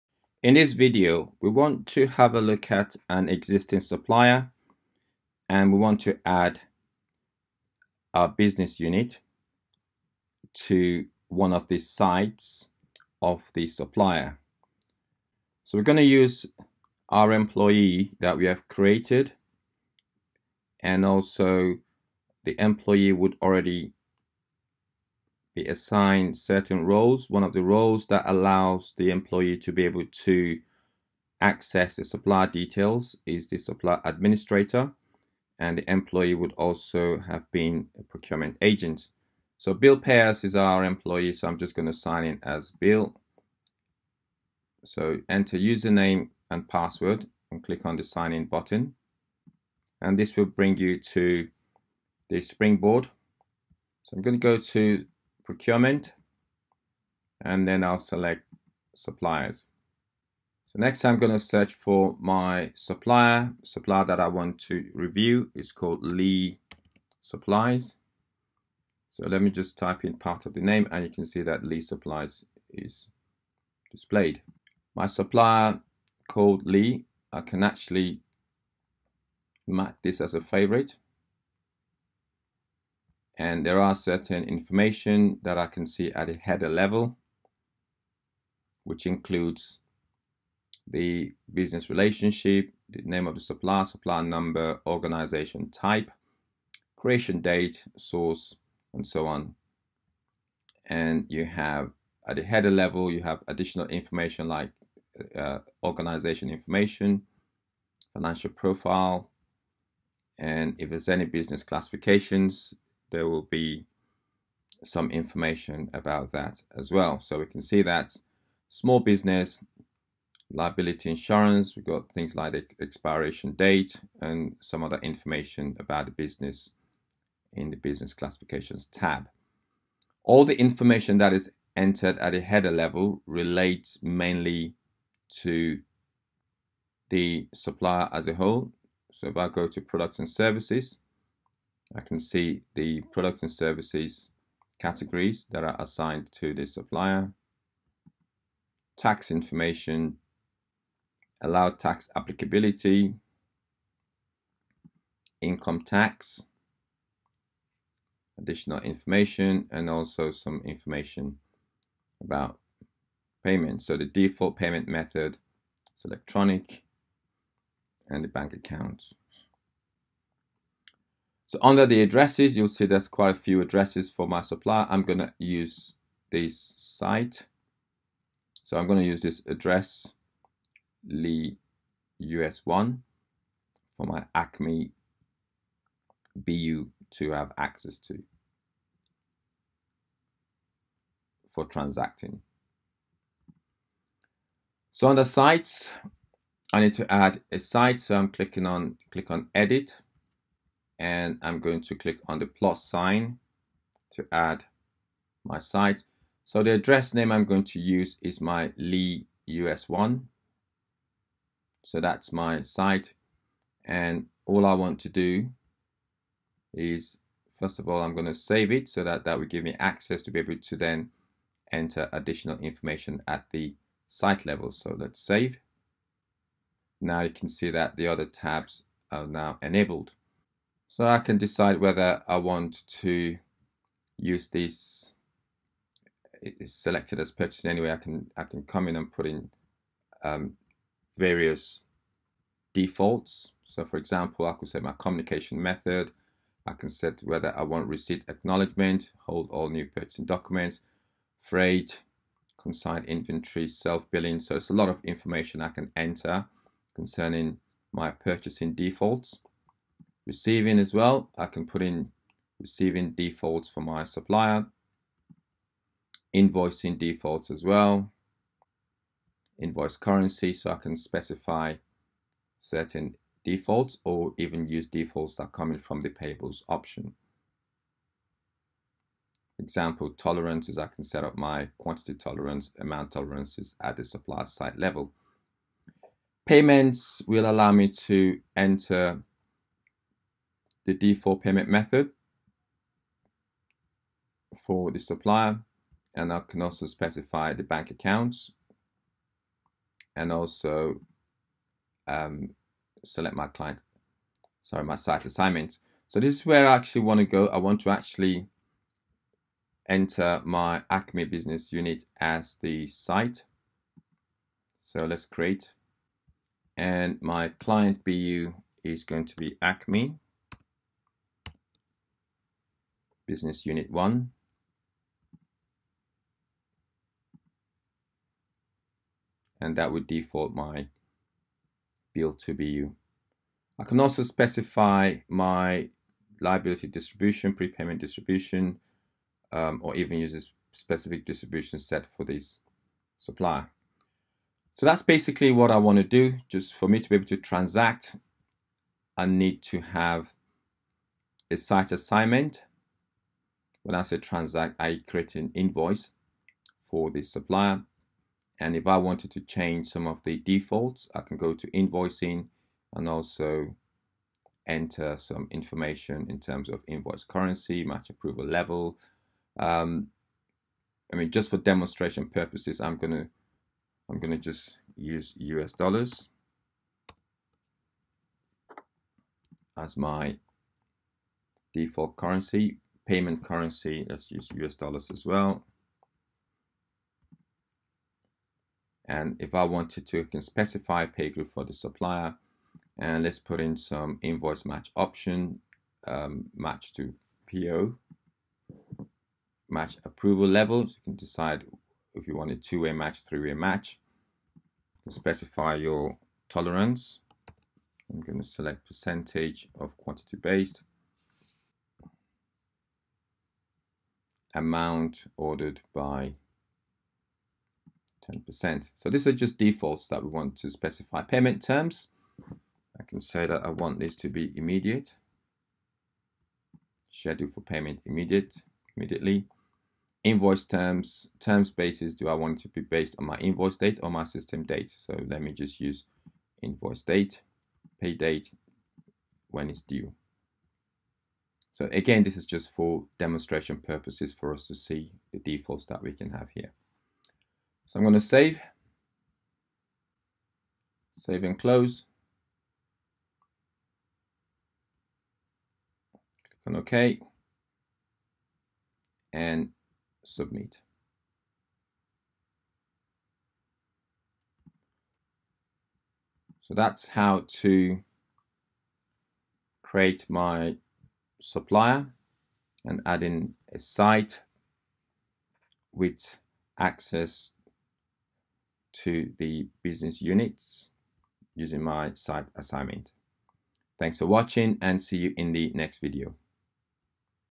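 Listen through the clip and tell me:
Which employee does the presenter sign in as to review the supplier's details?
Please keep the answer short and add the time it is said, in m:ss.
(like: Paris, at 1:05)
Bill Pears, at 0:39.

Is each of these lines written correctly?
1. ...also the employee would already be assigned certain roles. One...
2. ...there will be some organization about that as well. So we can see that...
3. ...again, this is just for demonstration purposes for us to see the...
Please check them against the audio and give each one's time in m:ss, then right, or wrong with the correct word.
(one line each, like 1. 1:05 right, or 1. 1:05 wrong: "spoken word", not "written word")
1. 0:21 right
2. 1:53 wrong: "information", not "organization"
3. 7:21 right.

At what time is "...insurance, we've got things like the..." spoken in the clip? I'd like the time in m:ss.
2:01.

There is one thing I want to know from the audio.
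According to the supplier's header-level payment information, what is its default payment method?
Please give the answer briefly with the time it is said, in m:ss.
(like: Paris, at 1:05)
Electronic, at 2:46.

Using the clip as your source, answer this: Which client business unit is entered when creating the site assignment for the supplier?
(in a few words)
Acme Business Unit 1.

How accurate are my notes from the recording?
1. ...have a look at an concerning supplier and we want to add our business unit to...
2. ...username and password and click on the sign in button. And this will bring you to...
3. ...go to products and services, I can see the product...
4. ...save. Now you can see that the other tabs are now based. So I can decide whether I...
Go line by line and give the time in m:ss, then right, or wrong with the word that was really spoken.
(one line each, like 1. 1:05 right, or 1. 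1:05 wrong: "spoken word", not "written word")
1. 0:02 wrong: "existing", not "concerning"
2. 0:45 right
3. 2:19 right
4. 3:45 wrong: "enabled", not "based".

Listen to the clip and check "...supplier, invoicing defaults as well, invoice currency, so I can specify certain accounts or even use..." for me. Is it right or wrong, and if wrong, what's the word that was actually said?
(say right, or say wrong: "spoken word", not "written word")
wrong: "defaults", not "accounts".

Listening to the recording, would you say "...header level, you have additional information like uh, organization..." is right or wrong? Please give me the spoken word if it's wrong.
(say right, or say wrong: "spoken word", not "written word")
right.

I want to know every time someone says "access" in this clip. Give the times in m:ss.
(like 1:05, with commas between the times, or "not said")
0:31, 3:07, 3:39, 7:56.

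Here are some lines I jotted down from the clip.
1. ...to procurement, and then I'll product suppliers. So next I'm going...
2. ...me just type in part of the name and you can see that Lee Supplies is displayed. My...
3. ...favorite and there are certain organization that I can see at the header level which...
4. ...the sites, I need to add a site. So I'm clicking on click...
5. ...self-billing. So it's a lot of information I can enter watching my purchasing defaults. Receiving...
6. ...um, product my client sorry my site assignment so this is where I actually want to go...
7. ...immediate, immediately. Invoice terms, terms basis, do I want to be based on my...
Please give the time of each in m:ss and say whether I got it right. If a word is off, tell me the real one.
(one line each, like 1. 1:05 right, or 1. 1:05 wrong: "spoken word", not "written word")
1. 0:54 wrong: "select", not "product"
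2. 1:09 right
3. 1:20 wrong: "information", not "organization"
4. 3:15 right
5. 4:13 wrong: "concerning", not "watching"
6. 5:02 wrong: "select", not "product"
7. 7:08 right.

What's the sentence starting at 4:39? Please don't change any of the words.
Example tolerances, I can set up my quantity tolerance, amount tolerances at the supplier site level.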